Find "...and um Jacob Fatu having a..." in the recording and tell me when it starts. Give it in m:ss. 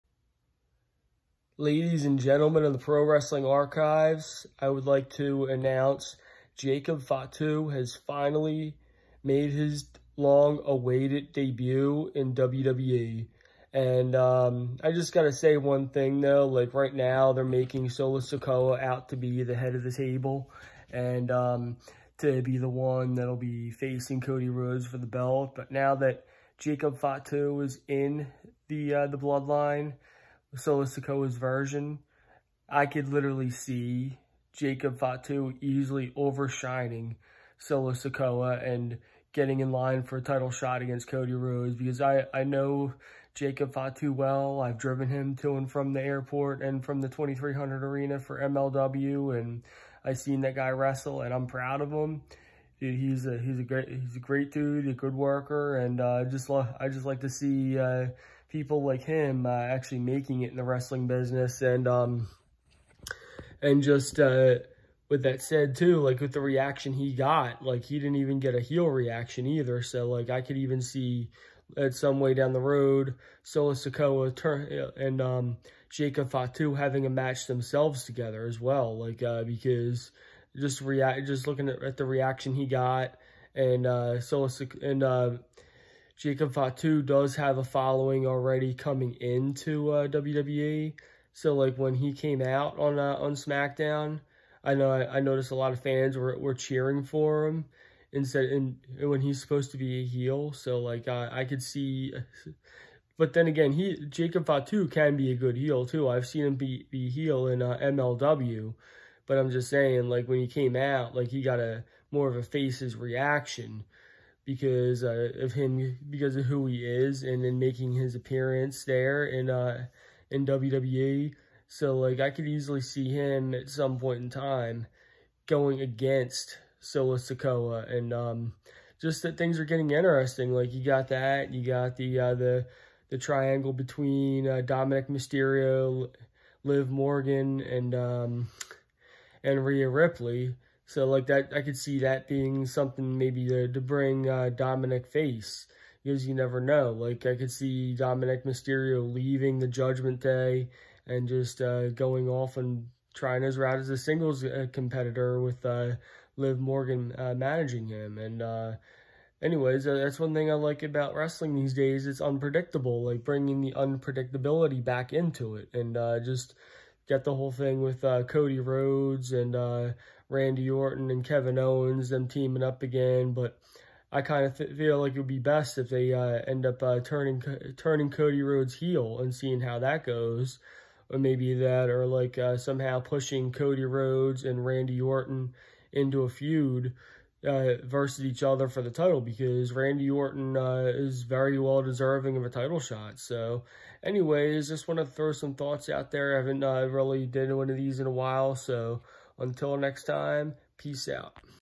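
1:14.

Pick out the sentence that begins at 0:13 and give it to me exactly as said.
And um, I just got to say one thing, though.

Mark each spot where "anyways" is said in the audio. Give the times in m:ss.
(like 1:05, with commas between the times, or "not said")
2:39, 3:14.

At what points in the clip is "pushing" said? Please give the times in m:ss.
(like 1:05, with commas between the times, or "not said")
3:03.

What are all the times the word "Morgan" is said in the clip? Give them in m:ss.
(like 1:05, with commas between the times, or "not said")
2:16, 2:36.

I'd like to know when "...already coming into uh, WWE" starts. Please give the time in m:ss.
1:28.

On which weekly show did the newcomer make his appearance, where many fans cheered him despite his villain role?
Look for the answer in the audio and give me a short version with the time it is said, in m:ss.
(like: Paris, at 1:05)
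SmackDown, at 1:33.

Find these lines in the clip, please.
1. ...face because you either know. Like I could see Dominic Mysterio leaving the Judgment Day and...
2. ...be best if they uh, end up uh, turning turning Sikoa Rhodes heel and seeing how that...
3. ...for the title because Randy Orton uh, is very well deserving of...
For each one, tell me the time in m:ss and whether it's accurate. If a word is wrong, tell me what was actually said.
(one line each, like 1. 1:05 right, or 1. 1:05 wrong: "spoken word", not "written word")
1. 2:25 wrong: "never", not "either"
2. 2:55 wrong: "Cody", not "Sikoa"
3. 3:08 right.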